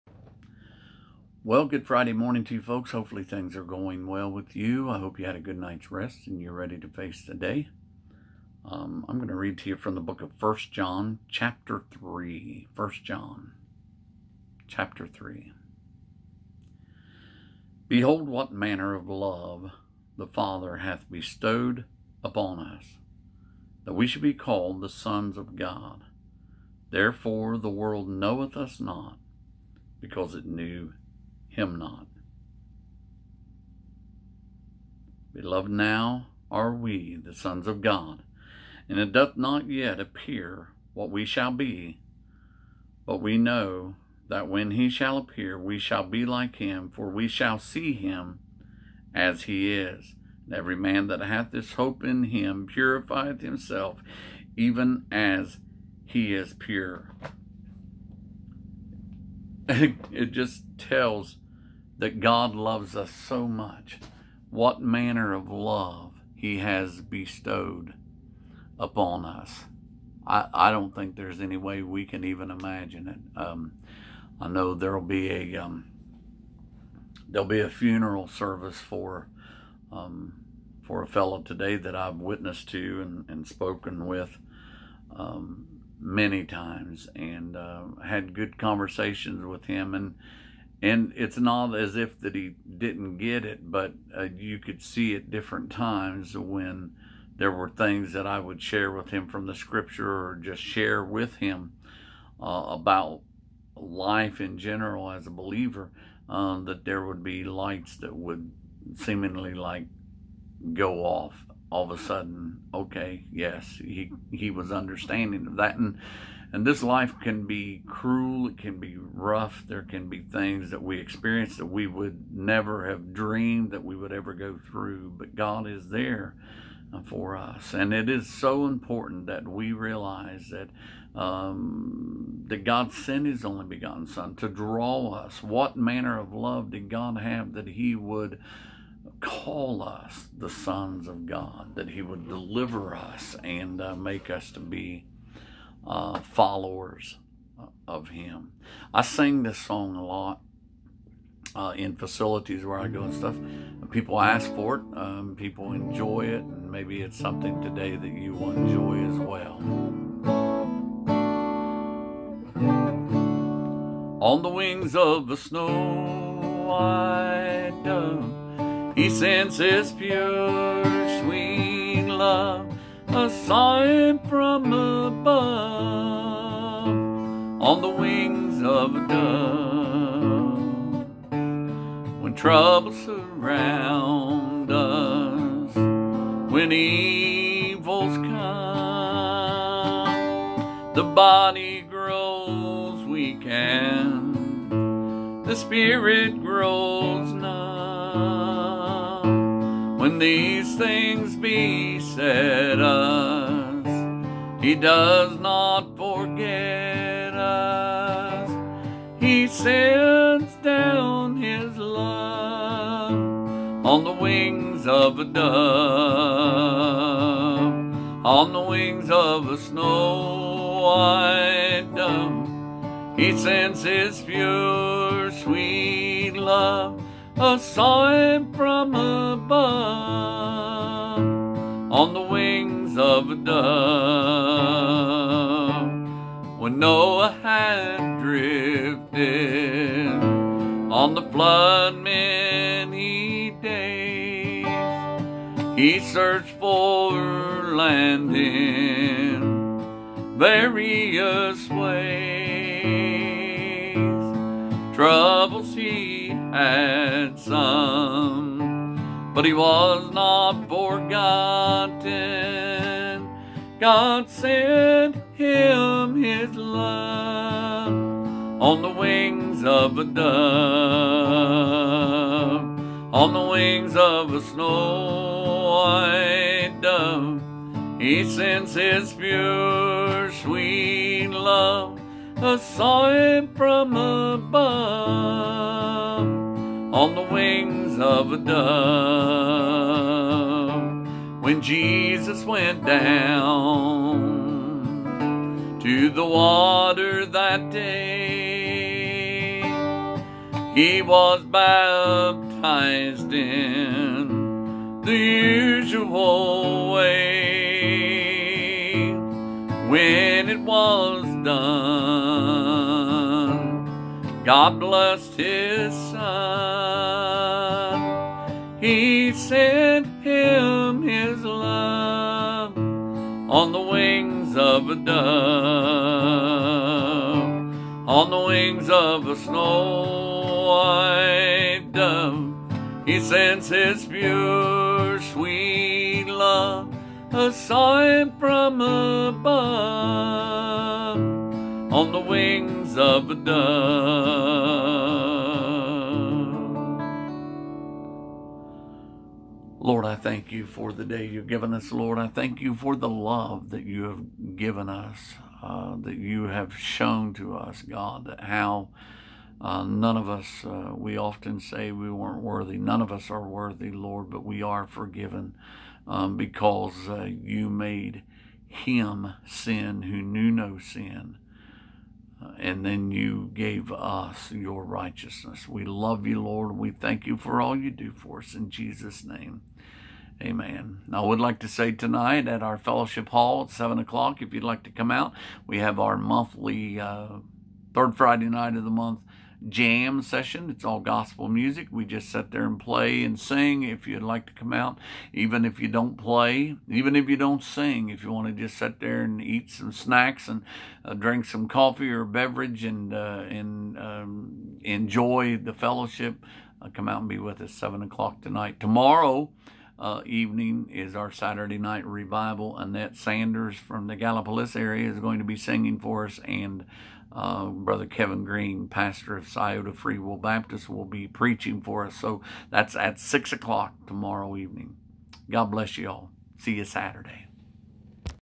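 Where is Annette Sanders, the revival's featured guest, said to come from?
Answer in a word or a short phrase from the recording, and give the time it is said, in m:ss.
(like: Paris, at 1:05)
Gallipolis, at 6:54.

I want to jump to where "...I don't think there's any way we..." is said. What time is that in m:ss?
1:10.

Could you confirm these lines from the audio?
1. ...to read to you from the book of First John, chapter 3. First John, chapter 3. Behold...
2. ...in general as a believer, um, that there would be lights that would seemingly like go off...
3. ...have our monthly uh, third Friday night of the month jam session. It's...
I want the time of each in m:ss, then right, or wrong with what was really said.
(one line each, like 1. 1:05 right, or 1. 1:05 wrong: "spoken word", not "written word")
1. 0:09 right
2. 1:44 right
3. 6:25 right.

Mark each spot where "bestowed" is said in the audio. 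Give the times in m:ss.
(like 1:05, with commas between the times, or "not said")
0:21, 1:06.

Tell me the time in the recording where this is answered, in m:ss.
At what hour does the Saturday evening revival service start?
7:03.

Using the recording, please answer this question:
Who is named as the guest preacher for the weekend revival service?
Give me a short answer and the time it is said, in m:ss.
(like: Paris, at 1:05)
Kevin Green, at 6:58.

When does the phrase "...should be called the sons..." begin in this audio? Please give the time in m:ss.
0:24.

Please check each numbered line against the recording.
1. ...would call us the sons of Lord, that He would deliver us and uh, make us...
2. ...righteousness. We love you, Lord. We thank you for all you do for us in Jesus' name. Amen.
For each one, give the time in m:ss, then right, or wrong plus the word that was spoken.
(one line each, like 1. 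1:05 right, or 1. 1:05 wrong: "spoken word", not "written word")
1. 2:17 wrong: "God", not "Lord"
2. 6:14 right.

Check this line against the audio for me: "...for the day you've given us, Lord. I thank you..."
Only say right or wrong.
right.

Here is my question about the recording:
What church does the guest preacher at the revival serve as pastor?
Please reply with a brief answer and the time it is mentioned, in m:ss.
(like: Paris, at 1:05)
Scioto Free Will Baptist, at 6:59.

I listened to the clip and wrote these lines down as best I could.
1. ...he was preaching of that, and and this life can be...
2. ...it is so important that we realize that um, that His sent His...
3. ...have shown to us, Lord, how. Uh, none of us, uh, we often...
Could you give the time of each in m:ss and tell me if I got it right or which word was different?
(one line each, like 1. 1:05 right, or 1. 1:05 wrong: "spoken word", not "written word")
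1. 1:54 wrong: "understanding", not "preaching"
2. 2:07 wrong: "God", not "His"
3. 5:56 wrong: "God", not "Lord".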